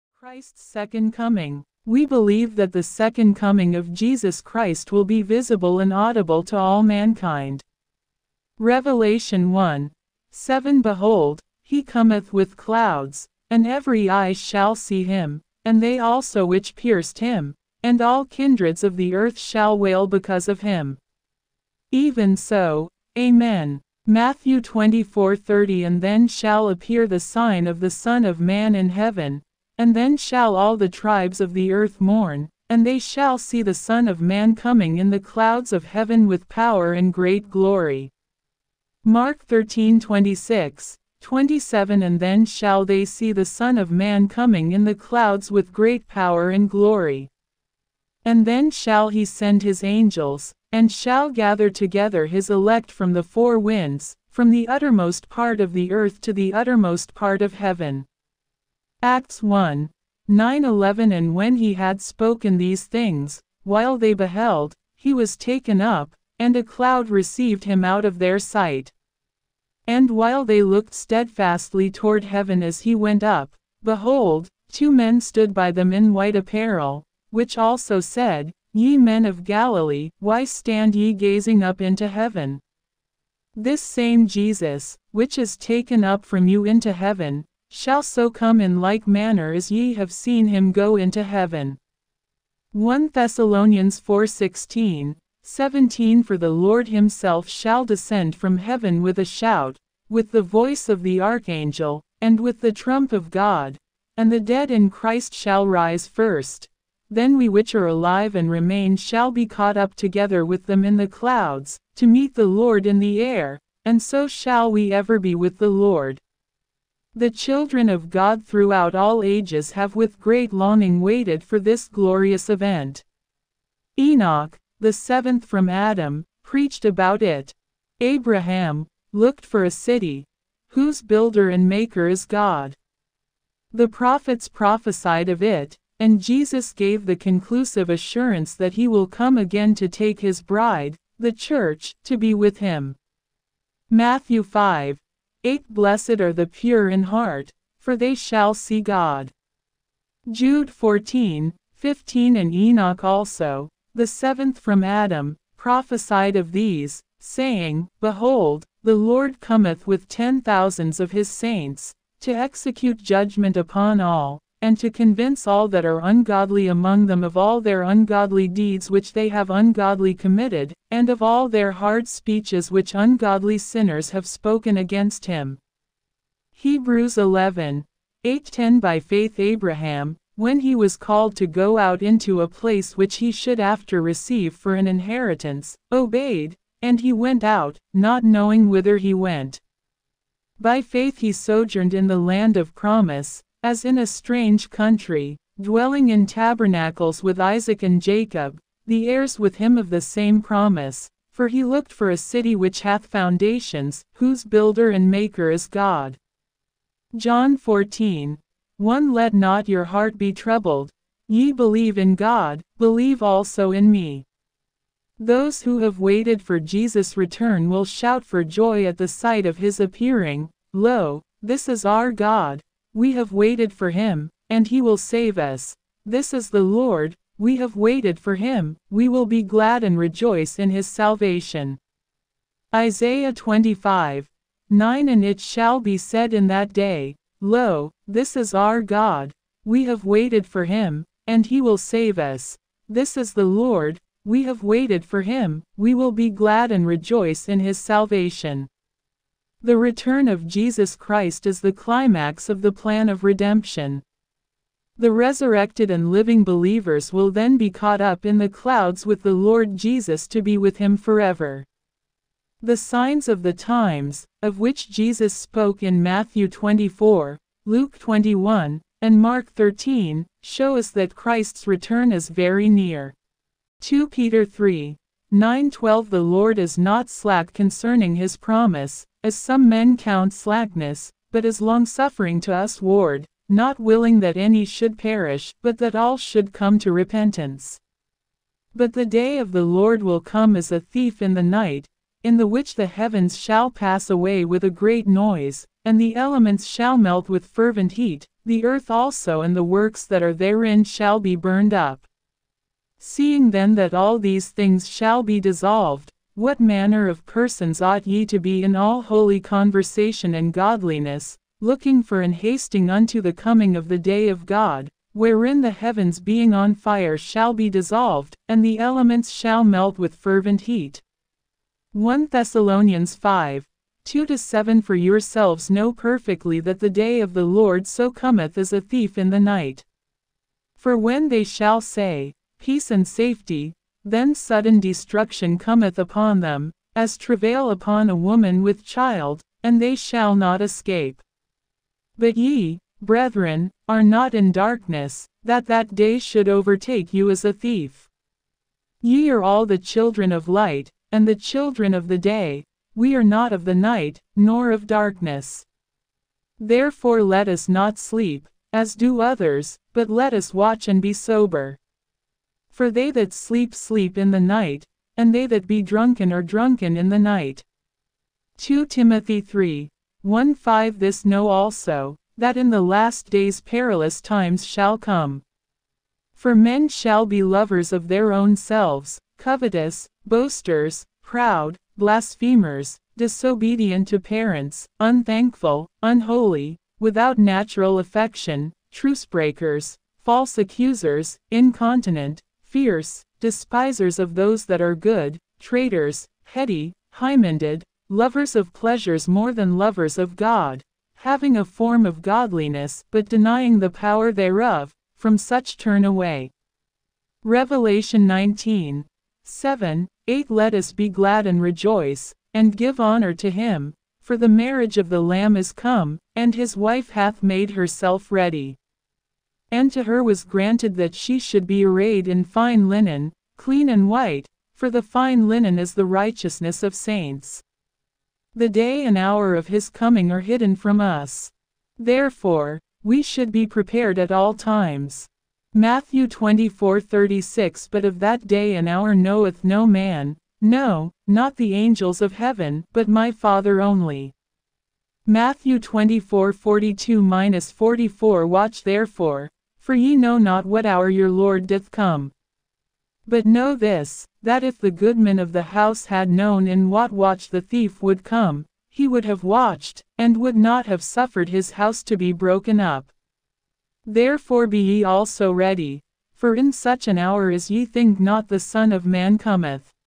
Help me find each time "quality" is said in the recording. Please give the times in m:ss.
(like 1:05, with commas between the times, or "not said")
not said.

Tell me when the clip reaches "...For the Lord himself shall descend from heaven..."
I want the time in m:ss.
1:36.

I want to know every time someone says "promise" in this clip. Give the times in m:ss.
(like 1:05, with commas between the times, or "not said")
3:12, 3:20, 4:38.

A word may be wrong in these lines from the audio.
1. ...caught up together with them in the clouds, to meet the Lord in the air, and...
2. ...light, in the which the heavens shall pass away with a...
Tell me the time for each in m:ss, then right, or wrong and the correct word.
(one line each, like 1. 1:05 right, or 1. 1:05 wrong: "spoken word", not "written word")
1. 1:49 right
2. 4:51 wrong: "night", not "light".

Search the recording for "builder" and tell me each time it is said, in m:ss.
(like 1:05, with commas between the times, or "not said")
2:11, 3:24.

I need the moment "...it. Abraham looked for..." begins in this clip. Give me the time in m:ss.
2:07.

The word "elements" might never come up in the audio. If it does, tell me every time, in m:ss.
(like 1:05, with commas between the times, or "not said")
4:56, 5:18.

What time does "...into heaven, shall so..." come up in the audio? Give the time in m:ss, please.
1:26.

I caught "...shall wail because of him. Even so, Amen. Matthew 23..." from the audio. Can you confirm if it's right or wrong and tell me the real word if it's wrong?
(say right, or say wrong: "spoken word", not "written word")
wrong: "24", not "23".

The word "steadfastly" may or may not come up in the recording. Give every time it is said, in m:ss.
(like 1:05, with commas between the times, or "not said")
1:10.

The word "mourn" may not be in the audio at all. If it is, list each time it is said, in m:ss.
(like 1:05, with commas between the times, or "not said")
0:31.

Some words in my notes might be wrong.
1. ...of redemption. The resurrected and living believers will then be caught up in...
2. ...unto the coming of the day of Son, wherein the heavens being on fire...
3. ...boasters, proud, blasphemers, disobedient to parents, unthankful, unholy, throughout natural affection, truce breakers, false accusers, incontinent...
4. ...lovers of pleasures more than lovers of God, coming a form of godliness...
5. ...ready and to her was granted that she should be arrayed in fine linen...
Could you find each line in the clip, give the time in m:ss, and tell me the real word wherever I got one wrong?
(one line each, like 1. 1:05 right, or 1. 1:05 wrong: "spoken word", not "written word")
1. 4:13 right
2. 5:12 wrong: "God", not "Son"
3. 6:20 wrong: "without", not "throughout"
4. 6:38 wrong: "having", not "coming"
5. 6:58 right.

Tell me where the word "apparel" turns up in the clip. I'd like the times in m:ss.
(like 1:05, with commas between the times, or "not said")
1:16.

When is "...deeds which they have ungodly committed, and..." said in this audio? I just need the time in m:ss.
2:48.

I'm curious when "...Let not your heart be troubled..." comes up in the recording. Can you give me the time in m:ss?
3:29.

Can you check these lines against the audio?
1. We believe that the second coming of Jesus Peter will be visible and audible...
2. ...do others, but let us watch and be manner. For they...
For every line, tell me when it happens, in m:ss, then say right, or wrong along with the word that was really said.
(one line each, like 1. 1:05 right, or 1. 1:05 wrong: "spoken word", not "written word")
1. 0:01 wrong: "Christ", not "Peter"
2. 5:58 wrong: "sober", not "manner".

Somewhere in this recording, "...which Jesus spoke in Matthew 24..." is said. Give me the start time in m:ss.
4:24.